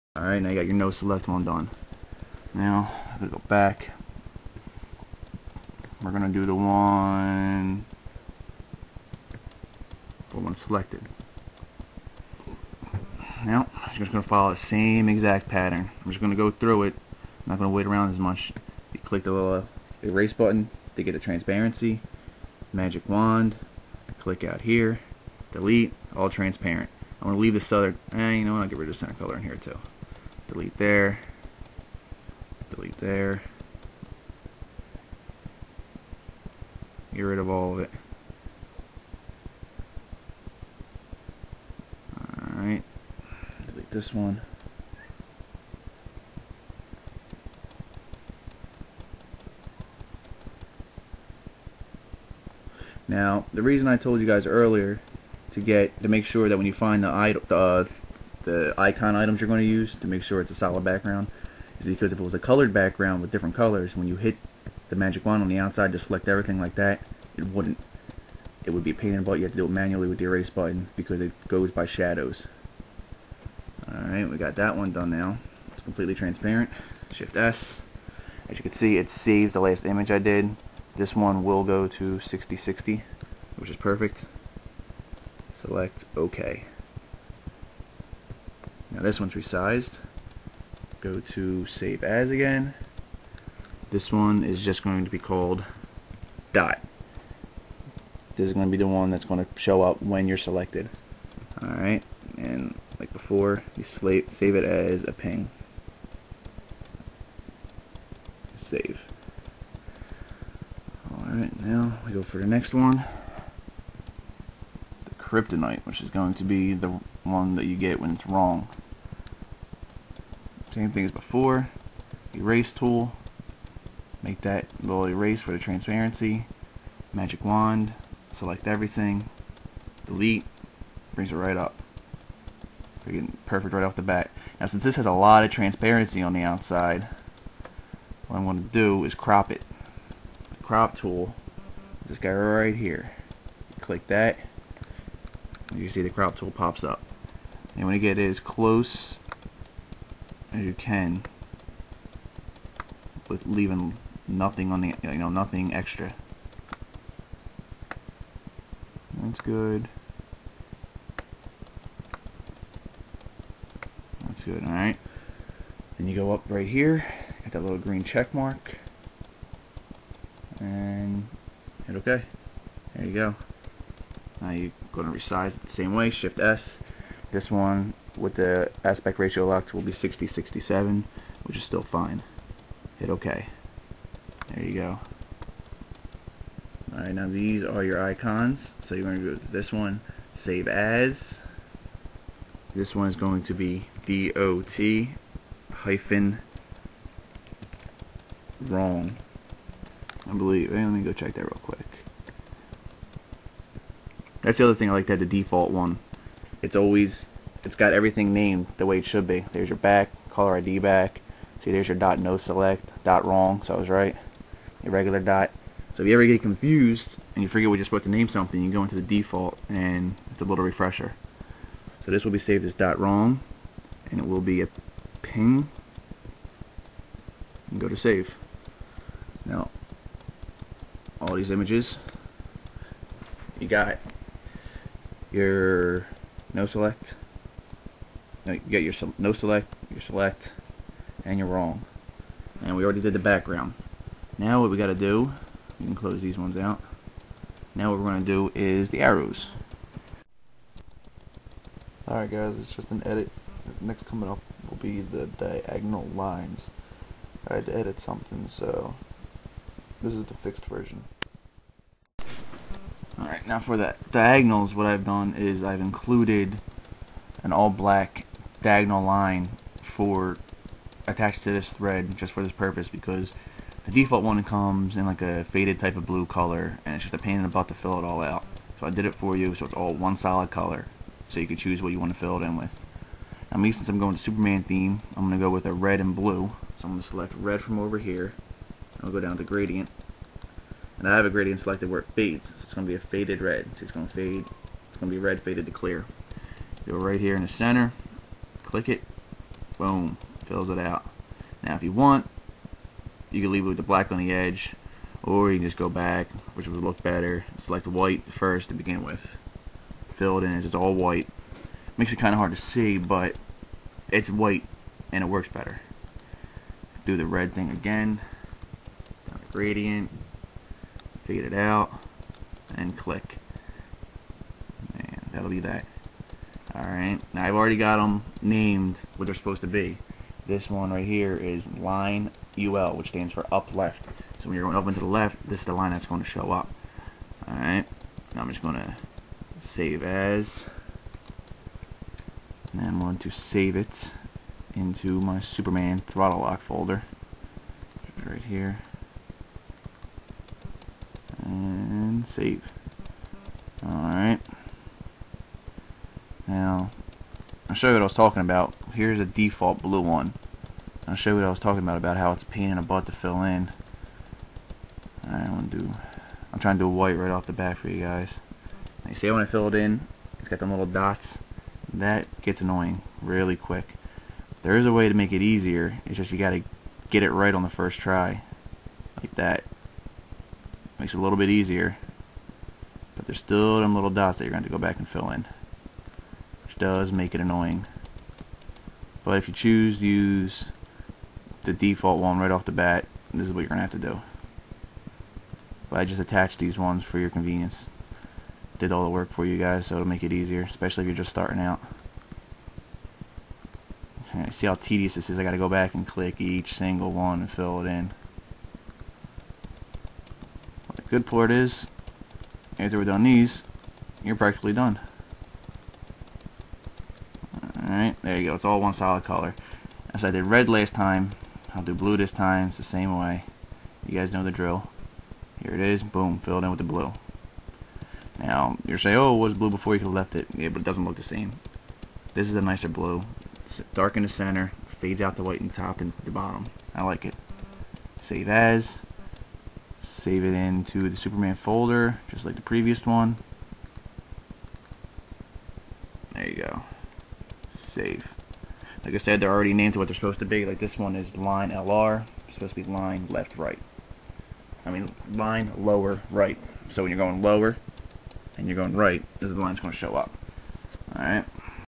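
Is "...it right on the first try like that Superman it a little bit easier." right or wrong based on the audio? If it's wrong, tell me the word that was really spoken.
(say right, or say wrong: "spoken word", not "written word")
wrong: "Makes", not "Superman".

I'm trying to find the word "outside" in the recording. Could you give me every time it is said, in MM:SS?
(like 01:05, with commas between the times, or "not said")
01:05, 02:16.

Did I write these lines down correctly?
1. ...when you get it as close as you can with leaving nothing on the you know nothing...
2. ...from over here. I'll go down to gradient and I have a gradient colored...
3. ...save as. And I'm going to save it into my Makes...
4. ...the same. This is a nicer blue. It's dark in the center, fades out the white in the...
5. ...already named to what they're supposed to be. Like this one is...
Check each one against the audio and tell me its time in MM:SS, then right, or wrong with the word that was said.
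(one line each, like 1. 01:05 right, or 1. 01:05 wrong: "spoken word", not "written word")
1. 02:27 right
2. 04:47 wrong: "selected", not "colored"
3. 05:39 wrong: "Superman", not "Makes"
4. 07:11 right
5. 07:29 right.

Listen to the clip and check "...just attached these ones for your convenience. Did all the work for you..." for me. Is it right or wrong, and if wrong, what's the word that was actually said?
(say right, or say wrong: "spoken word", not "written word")
right.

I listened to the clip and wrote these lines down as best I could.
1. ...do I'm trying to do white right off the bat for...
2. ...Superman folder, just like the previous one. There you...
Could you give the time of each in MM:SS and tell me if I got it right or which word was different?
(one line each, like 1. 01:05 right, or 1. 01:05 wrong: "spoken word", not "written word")
1. 06:05 right
2. 07:21 right.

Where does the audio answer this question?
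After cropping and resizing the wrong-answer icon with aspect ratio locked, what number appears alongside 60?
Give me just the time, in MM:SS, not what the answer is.
02:59.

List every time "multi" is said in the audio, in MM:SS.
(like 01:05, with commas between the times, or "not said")
not said.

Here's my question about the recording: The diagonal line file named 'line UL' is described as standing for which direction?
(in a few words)
up left.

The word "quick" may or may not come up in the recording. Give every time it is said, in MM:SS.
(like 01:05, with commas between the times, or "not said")
03:21, 06:13.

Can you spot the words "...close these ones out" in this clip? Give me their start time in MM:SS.
04:05.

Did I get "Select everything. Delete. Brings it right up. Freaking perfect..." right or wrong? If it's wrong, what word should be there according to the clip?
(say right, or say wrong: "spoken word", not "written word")
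right.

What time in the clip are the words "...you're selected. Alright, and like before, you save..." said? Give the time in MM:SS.
01:40.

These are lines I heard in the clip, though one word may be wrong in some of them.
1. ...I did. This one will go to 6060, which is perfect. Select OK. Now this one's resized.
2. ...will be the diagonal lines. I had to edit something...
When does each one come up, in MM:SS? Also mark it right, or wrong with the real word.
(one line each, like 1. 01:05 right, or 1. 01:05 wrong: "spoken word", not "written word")
1. 01:20 right
2. 04:14 right.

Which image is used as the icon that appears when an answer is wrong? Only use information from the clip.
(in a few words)
kryptonite.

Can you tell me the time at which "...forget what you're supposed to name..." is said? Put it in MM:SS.
03:37.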